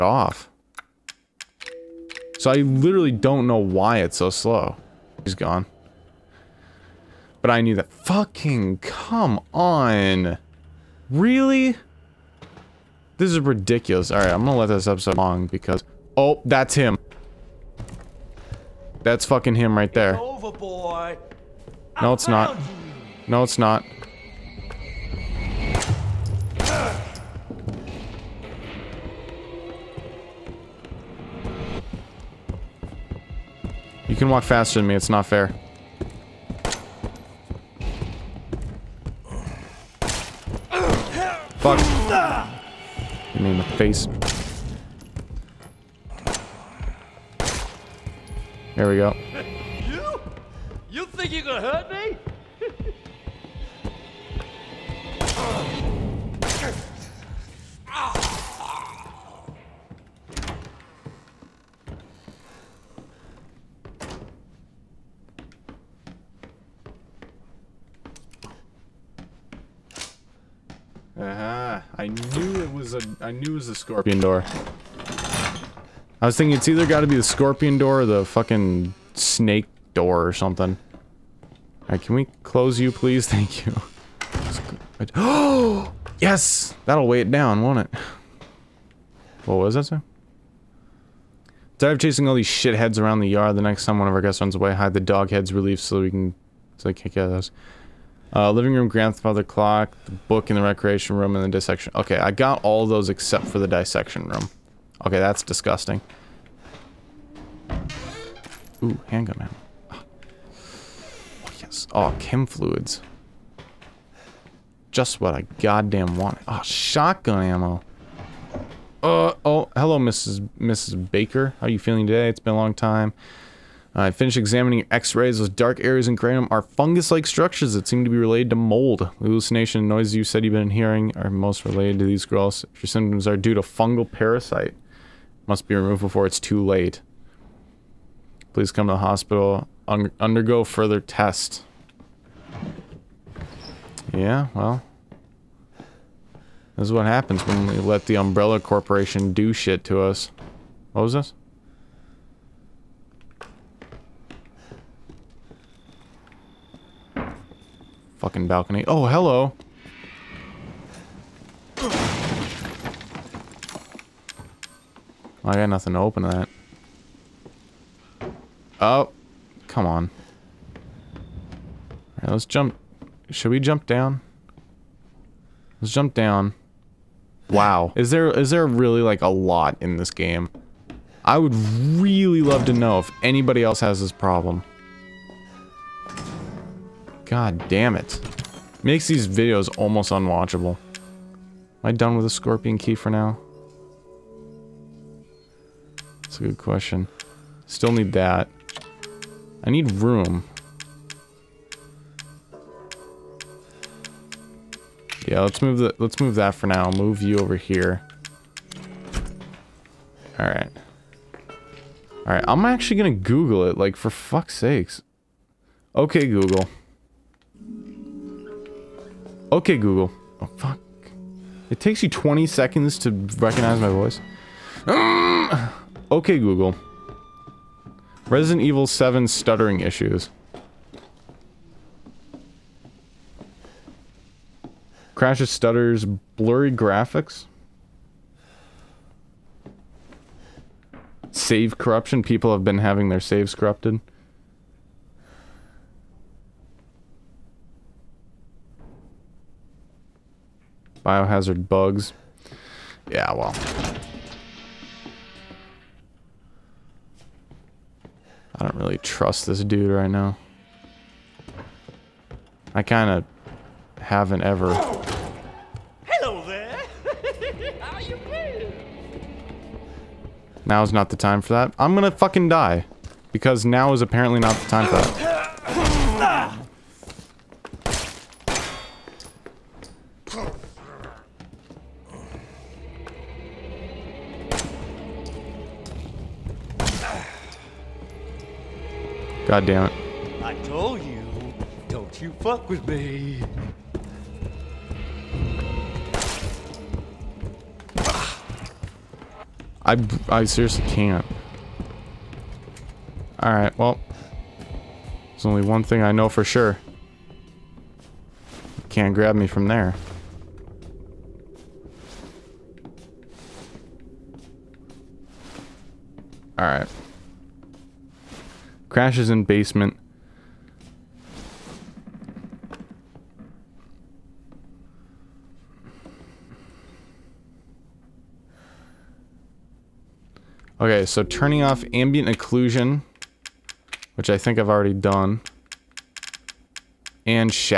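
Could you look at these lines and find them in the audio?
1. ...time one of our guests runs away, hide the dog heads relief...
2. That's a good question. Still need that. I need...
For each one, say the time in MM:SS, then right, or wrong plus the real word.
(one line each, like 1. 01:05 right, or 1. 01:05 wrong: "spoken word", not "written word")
1. 01:33 right
2. 03:16 right.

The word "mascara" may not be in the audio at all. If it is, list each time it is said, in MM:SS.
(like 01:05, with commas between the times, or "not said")
not said.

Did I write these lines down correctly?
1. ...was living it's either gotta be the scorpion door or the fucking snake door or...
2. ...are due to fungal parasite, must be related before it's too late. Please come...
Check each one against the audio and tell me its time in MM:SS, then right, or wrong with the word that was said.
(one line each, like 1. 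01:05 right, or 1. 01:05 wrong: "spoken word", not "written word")
1. 01:16 wrong: "thinking", not "living"
2. 02:13 wrong: "removed", not "related".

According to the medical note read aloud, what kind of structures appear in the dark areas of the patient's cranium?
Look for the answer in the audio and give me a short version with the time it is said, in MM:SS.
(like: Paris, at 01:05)
fungus-like structures, at 02:06.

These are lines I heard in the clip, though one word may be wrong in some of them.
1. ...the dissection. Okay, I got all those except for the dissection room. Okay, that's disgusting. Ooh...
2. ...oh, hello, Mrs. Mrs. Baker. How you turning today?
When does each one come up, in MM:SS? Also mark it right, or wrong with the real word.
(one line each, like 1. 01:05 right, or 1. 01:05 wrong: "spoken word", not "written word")
1. 01:41 right
2. 01:59 wrong: "feeling", not "turning".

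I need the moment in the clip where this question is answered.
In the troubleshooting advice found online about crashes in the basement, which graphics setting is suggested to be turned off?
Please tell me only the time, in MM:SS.
05:31.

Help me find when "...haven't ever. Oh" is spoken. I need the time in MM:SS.
04:24.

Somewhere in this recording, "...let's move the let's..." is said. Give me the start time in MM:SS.
03:25.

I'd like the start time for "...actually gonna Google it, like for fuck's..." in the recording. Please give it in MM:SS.
03:32.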